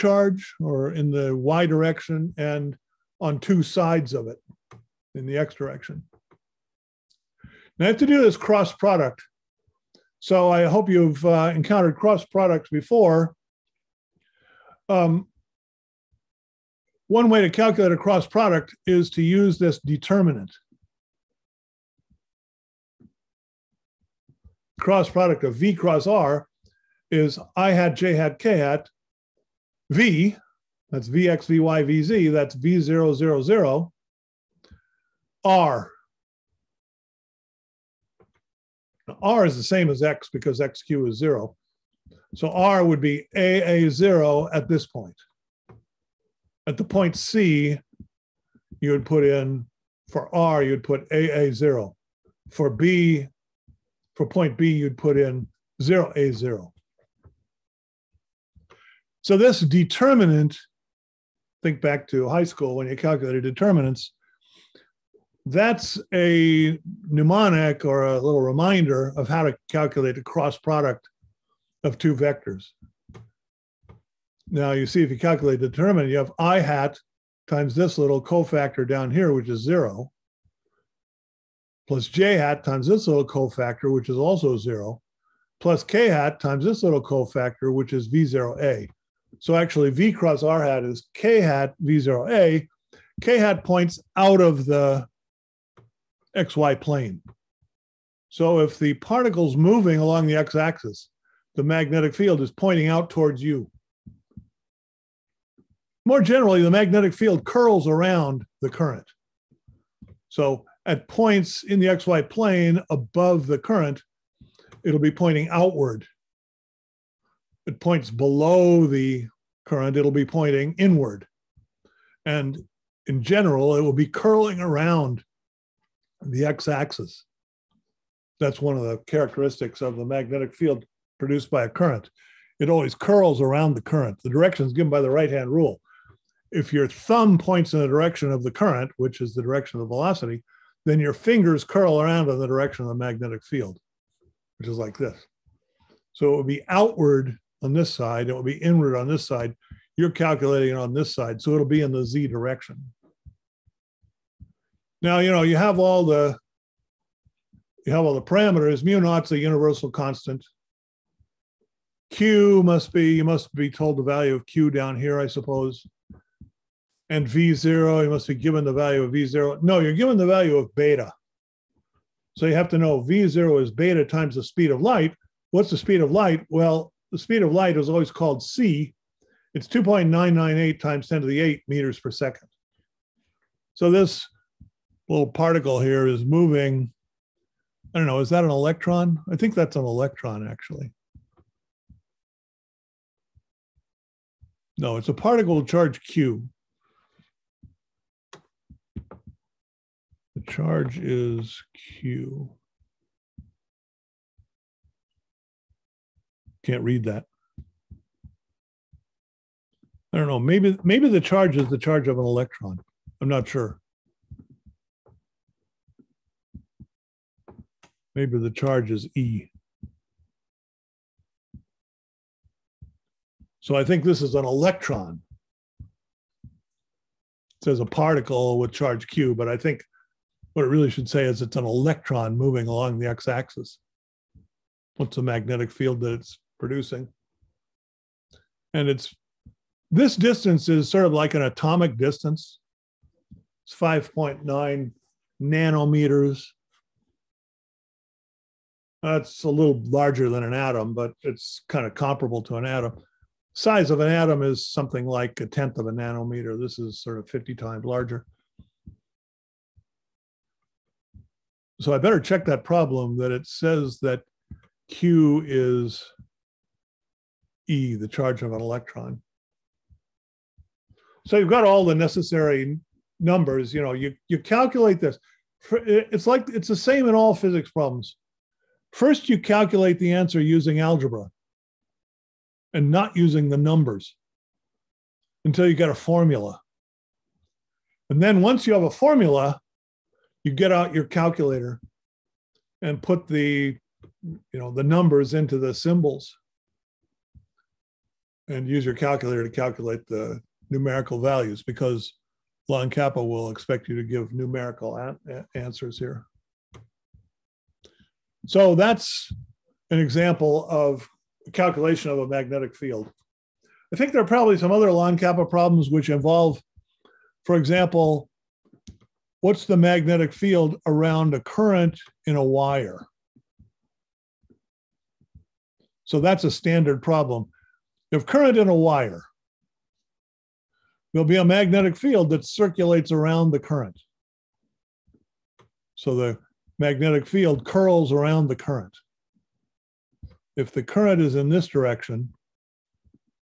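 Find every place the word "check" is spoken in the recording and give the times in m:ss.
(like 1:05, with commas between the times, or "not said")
4:22.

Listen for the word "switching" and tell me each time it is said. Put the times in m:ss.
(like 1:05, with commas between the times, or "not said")
not said.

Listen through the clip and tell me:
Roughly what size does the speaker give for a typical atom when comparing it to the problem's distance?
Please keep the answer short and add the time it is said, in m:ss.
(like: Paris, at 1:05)
a tenth of a nanometer, at 4:15.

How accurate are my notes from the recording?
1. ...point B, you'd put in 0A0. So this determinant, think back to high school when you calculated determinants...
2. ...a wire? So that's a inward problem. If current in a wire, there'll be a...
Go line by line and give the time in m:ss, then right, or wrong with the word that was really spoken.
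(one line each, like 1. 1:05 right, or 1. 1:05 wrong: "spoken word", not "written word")
1. 0:54 right
2. 5:22 wrong: "standard", not "inward".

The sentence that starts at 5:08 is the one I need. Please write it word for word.
So that's an example of calculation of a magnetic field.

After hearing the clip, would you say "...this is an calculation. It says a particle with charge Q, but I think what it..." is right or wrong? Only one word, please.
wrong.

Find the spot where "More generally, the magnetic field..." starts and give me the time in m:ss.
1:46.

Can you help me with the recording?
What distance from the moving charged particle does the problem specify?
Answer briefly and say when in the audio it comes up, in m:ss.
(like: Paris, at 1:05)
5.9 nanometers, at 4:03.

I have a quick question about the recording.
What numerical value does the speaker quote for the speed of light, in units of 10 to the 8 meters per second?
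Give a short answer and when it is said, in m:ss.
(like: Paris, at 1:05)
2.998, at 2:59.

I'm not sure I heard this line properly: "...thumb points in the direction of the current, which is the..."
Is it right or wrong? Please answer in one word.
right.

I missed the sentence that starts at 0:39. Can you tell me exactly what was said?
Now, R is the same as X because XQ is zero.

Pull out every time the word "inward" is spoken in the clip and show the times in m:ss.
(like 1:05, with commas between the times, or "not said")
2:00, 2:28.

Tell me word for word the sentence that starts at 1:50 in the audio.
So at points in the xy plane above the current, it'll be pointing outward.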